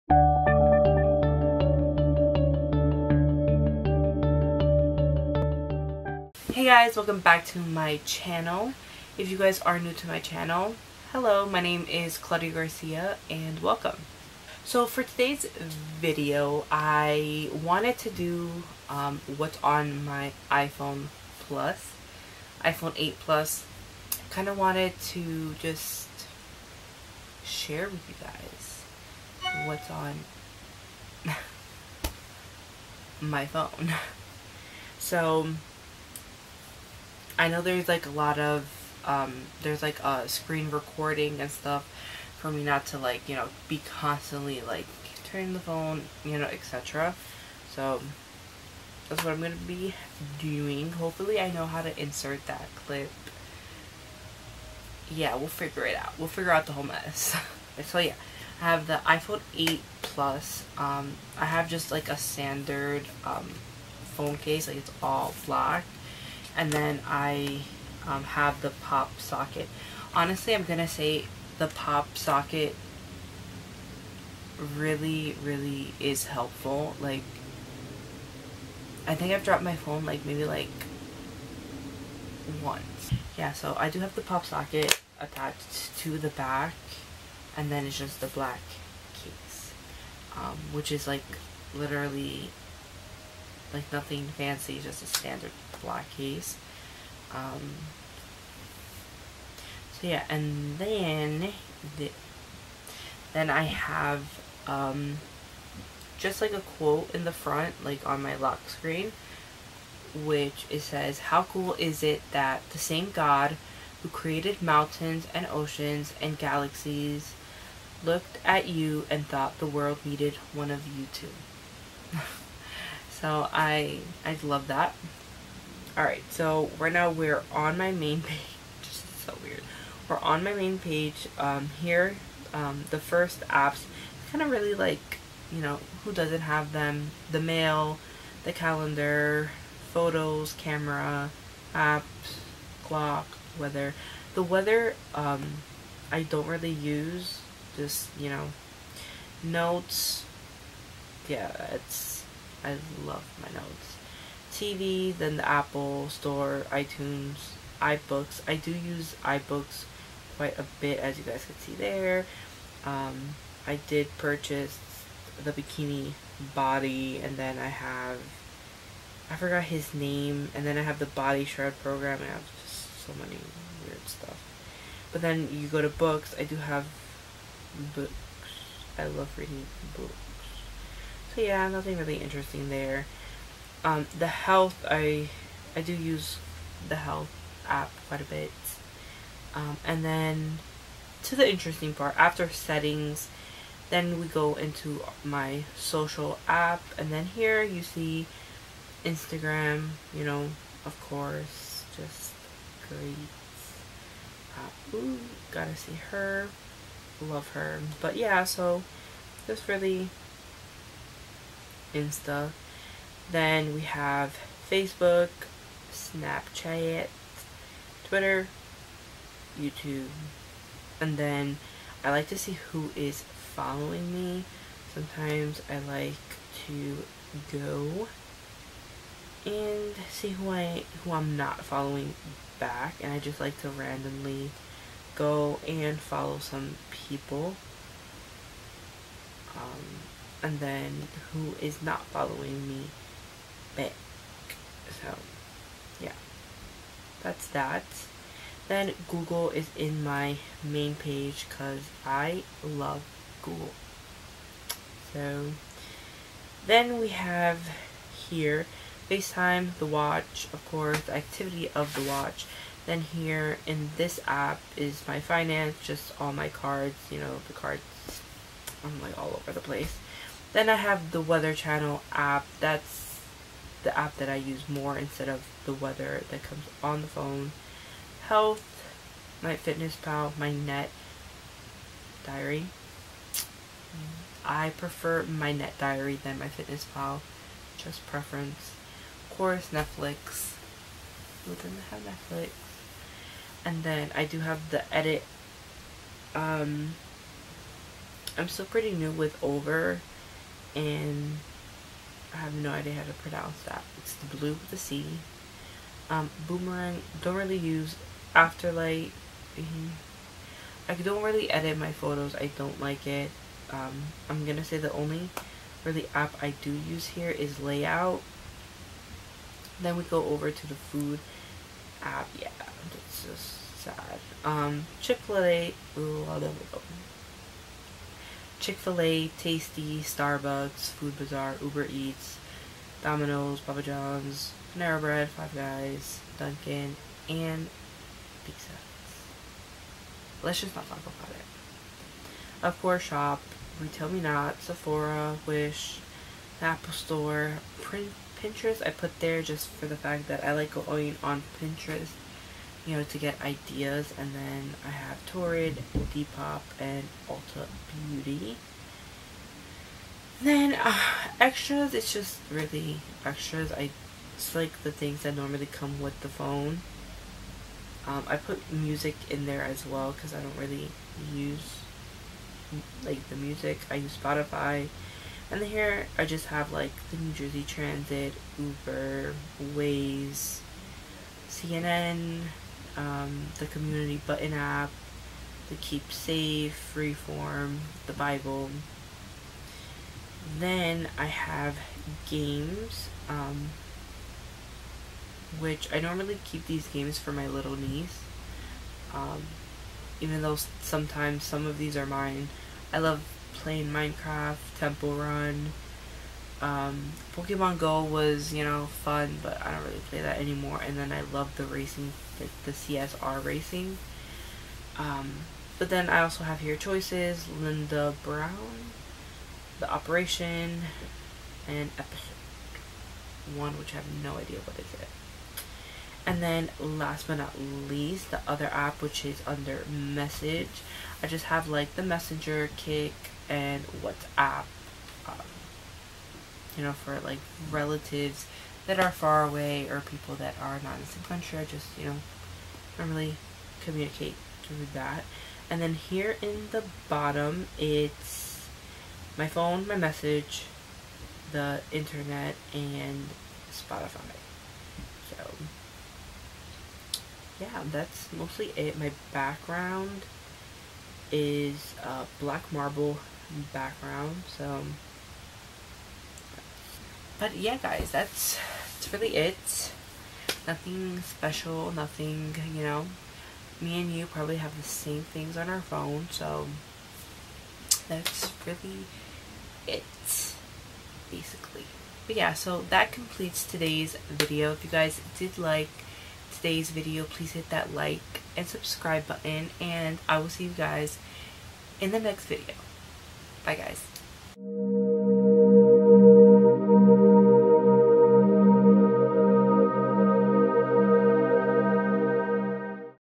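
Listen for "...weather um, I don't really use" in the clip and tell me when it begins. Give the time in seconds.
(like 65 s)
144 s.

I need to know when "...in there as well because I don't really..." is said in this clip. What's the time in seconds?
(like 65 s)
369 s.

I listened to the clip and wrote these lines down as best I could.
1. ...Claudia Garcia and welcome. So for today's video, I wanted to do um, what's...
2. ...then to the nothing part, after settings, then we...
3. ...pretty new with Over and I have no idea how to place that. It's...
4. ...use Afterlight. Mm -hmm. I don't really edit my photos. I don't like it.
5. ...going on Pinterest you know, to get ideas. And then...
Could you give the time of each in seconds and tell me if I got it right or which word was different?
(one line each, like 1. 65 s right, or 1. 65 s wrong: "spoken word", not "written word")
1. 12 s right
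2. 190 s wrong: "interesting", not "nothing"
3. 298 s wrong: "pronounce", not "place"
4. 307 s right
5. 350 s right.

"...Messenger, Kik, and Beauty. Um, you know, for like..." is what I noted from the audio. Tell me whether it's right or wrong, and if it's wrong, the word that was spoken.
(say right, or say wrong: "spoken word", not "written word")
wrong: "WhatsApp", not "Beauty".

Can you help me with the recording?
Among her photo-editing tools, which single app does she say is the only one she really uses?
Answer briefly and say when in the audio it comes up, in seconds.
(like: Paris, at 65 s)
Layout, at 317 s.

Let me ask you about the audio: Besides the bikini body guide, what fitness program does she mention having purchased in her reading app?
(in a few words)
body shred program.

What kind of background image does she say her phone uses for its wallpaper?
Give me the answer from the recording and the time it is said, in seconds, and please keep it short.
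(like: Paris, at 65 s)
black marble, at 462 s.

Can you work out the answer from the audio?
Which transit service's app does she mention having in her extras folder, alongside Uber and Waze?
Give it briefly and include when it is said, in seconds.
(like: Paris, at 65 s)
New Jersey Transit, at 377 s.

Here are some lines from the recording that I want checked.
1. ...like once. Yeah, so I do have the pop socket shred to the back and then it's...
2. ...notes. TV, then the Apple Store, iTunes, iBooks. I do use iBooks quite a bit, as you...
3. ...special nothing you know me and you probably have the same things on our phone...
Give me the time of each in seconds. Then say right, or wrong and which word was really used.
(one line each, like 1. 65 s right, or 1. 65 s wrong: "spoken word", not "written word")
1. 80 s wrong: "attached", not "shred"
2. 153 s right
3. 471 s right.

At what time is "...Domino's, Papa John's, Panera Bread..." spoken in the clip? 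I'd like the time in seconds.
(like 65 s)
333 s.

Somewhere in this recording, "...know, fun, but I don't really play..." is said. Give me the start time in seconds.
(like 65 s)
408 s.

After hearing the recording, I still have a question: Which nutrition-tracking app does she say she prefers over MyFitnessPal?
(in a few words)
MyNetDiary.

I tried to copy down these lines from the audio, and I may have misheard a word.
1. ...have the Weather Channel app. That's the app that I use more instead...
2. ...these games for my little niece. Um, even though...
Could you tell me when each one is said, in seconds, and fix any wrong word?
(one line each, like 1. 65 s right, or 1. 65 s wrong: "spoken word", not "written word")
1. 270 s right
2. 396 s right.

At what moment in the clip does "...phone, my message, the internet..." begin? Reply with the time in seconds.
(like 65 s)
449 s.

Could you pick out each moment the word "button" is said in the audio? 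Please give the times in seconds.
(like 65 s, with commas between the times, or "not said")
384 s, 489 s.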